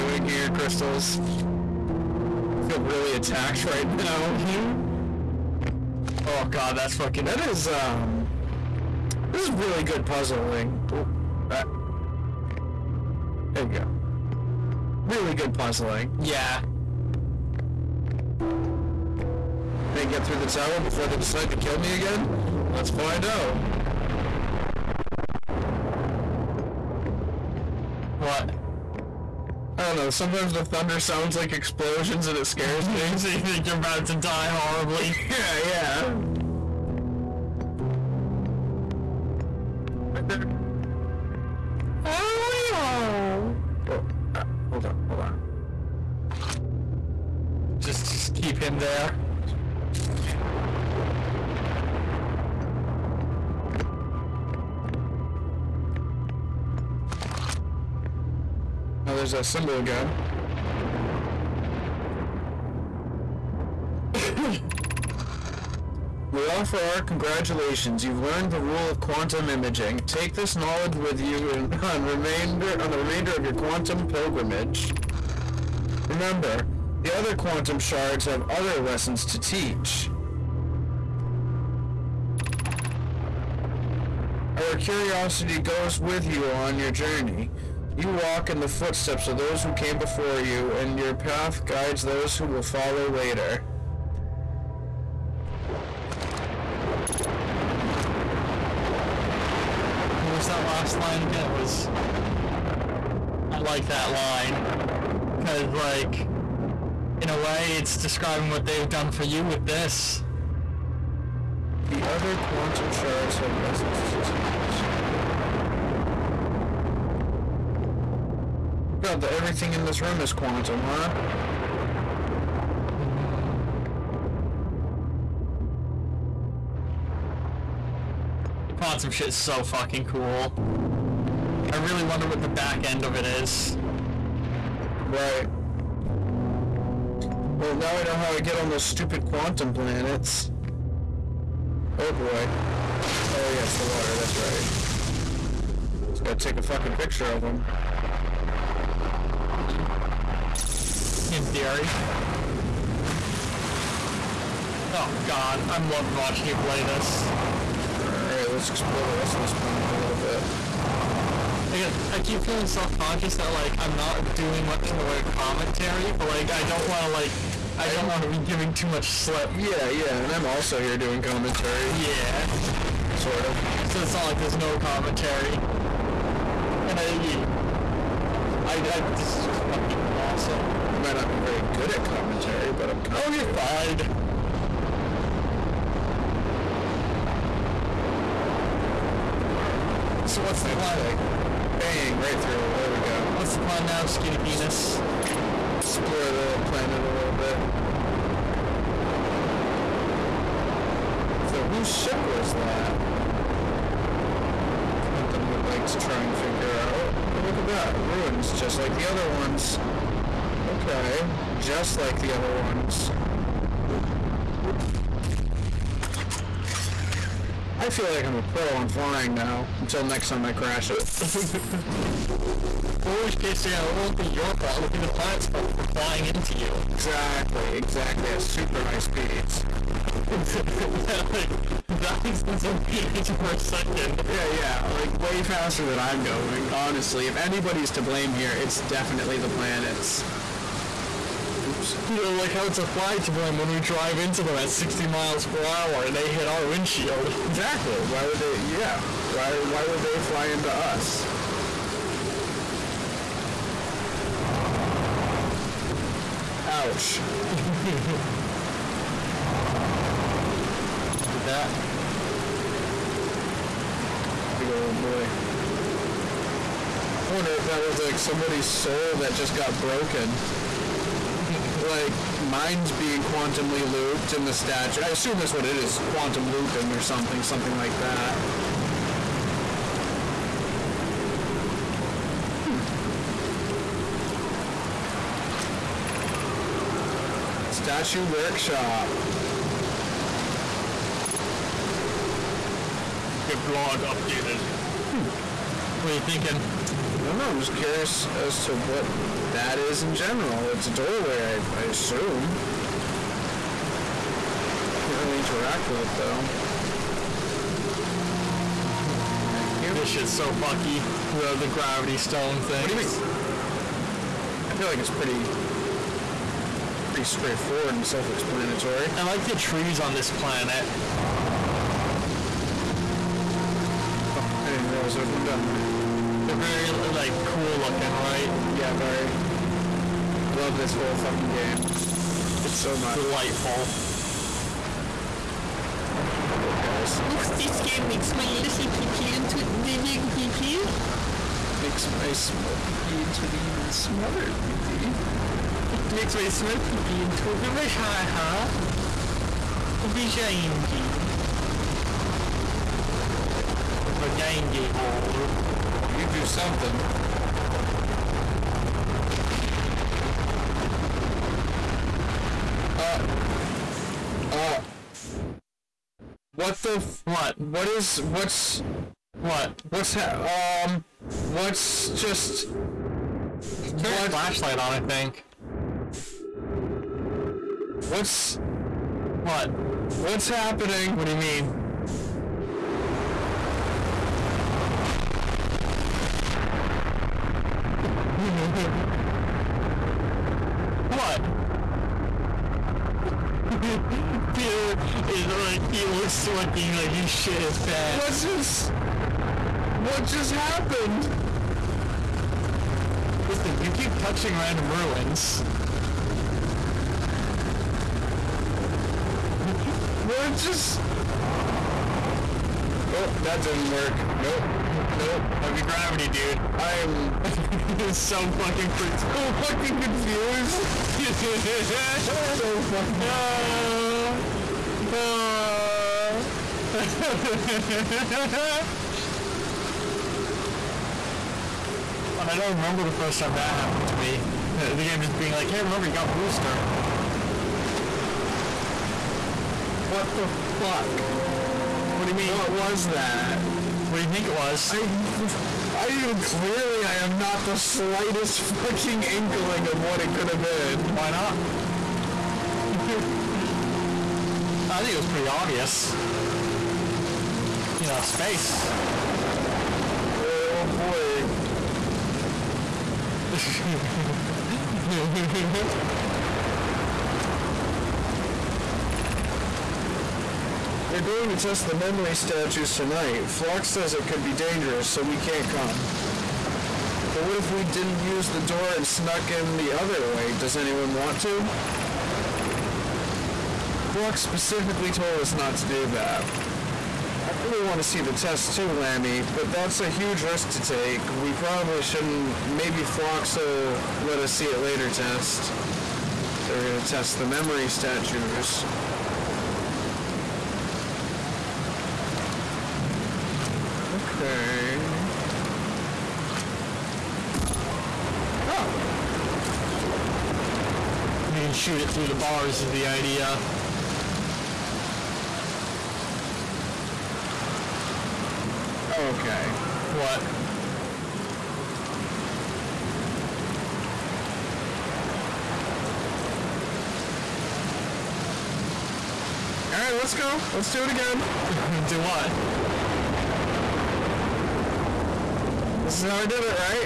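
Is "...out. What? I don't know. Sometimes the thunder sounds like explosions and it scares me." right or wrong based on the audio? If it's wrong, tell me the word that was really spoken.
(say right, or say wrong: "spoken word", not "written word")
right.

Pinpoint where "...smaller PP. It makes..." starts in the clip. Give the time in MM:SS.
05:43.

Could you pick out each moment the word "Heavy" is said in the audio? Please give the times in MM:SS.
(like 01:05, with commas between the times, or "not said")
06:55.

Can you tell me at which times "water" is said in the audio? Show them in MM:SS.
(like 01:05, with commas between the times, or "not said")
02:23.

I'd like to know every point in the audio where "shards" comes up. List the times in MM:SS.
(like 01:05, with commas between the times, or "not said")
01:17, 01:52.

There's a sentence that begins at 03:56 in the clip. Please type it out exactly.
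Honestly, if anybody's to blame here, it's definitely the planets.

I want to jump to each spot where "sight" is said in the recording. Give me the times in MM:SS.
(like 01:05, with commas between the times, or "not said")
not said.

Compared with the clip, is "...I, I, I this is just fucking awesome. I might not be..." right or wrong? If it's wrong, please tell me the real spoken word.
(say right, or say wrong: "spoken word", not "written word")
right.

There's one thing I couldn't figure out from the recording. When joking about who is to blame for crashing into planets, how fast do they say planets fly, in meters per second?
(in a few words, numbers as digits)
Thousands.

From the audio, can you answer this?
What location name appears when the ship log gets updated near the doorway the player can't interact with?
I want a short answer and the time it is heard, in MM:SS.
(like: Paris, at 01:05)
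Statue Workshop, at 04:47.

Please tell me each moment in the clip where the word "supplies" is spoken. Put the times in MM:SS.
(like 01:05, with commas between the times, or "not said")
not said.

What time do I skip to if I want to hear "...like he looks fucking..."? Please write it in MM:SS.
06:35.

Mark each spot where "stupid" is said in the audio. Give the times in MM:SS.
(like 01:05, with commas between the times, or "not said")
02:18.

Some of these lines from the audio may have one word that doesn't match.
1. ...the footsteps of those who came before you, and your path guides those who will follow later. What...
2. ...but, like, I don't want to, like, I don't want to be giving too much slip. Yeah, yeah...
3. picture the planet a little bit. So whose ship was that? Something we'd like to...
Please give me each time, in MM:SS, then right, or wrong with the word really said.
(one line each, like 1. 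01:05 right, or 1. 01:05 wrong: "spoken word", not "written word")
1. 01:28 right
2. 02:46 right
3. 03:15 wrong: "explore", not "picture".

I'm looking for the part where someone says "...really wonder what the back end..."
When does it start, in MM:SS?
02:11.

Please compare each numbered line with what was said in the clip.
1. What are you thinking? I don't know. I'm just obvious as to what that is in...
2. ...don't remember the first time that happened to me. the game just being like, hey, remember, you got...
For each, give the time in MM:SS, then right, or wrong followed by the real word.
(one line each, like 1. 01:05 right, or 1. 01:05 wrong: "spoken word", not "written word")
1. 04:56 wrong: "curious", not "obvious"
2. 07:12 right.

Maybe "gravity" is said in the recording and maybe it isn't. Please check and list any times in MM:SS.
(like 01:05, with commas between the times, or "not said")
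05:11, 06:55.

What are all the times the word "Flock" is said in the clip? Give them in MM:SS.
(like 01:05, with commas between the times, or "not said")
07:53, 08:04.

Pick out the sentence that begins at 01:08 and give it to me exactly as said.
You've learned the rule of quantum imaging.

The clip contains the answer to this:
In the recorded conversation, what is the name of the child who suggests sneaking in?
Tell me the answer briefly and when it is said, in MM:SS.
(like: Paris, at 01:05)
Lammy, at 08:08.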